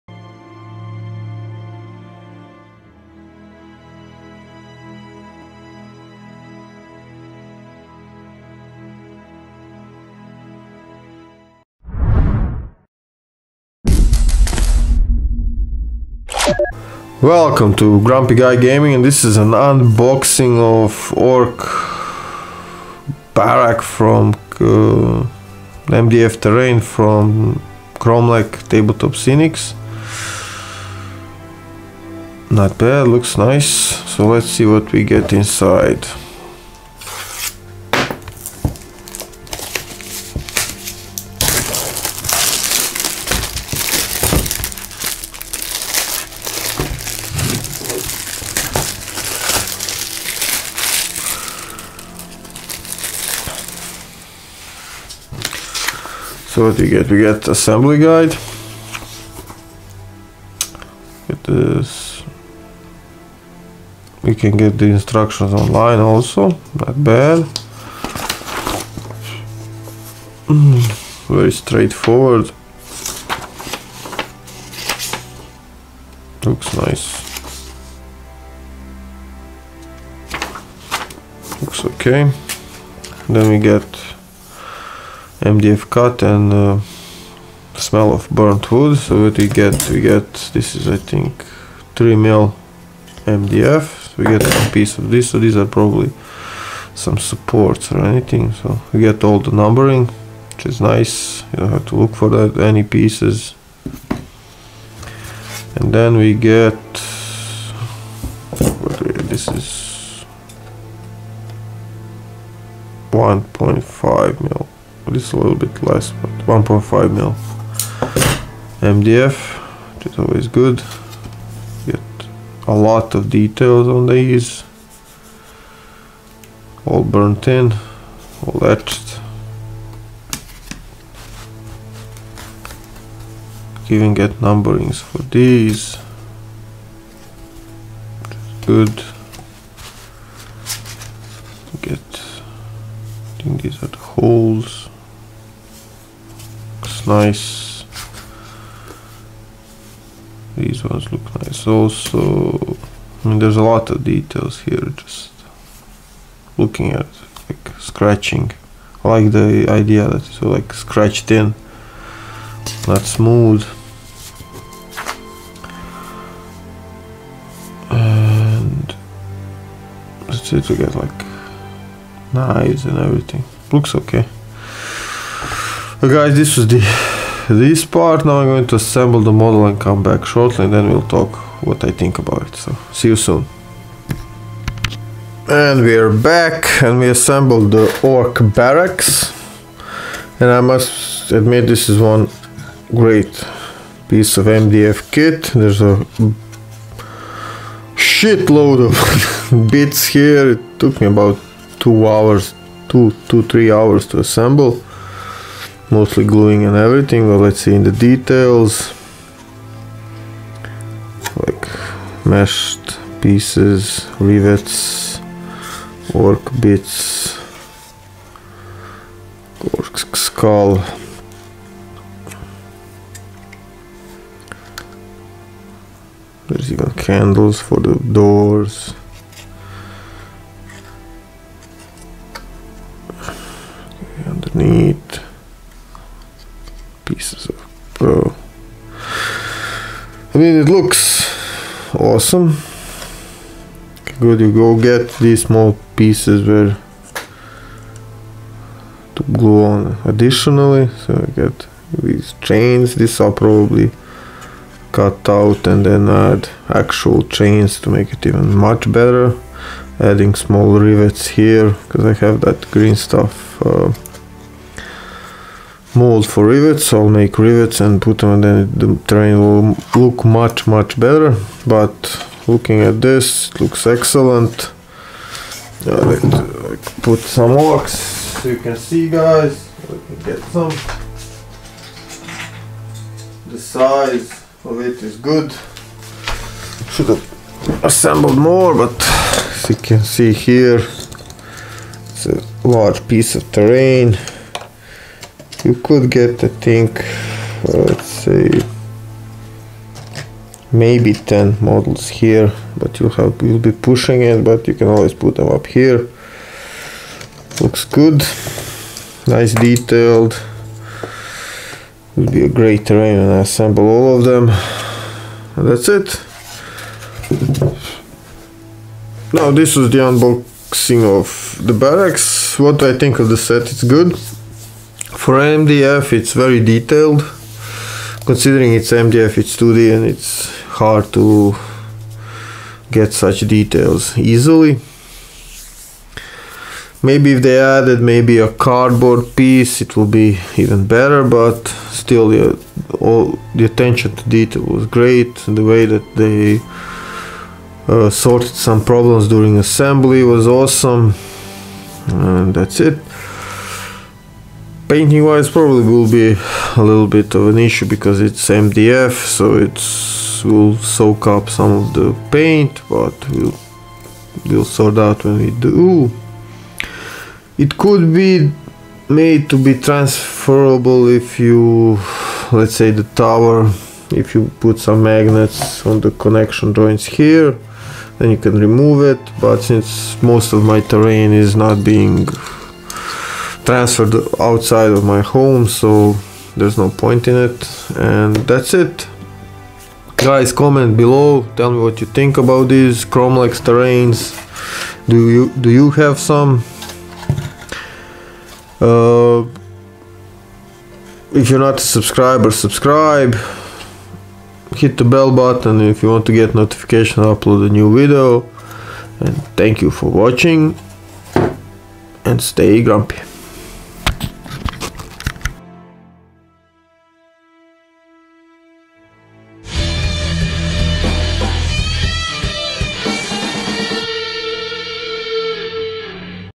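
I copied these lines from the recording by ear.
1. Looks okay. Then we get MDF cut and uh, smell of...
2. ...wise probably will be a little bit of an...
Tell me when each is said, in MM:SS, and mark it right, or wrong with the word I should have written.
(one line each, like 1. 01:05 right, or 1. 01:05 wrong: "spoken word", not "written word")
1. 01:21 right
2. 05:55 right.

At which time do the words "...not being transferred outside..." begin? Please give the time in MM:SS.
06:21.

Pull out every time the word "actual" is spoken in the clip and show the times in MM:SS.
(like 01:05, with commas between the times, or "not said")
04:16.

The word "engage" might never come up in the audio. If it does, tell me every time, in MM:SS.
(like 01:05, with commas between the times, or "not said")
not said.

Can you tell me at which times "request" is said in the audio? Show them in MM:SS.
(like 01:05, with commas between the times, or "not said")
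not said.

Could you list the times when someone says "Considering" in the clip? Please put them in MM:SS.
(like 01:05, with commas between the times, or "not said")
05:28.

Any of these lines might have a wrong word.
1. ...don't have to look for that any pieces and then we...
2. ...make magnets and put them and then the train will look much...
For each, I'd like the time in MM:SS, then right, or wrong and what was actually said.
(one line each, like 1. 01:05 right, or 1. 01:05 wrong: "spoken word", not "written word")
1. 01:41 right
2. 04:27 wrong: "rivets", not "magnets".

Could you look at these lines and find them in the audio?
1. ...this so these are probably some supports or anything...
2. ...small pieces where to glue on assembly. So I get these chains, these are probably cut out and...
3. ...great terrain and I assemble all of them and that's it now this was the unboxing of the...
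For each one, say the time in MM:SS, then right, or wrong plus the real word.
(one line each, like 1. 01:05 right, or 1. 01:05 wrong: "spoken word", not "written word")
1. 01:35 right
2. 04:05 wrong: "additionally", not "assembly"
3. 05:12 right.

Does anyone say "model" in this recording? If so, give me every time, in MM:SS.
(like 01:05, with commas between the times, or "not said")
02:59, 05:01.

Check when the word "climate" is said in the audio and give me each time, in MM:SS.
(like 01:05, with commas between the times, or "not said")
not said.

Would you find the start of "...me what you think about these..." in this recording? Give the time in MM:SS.
06:31.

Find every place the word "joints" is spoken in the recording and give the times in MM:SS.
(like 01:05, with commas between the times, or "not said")
06:16.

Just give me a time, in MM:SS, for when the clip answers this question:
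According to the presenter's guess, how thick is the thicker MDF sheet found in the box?
01:31.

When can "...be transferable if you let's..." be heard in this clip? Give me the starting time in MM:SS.
06:09.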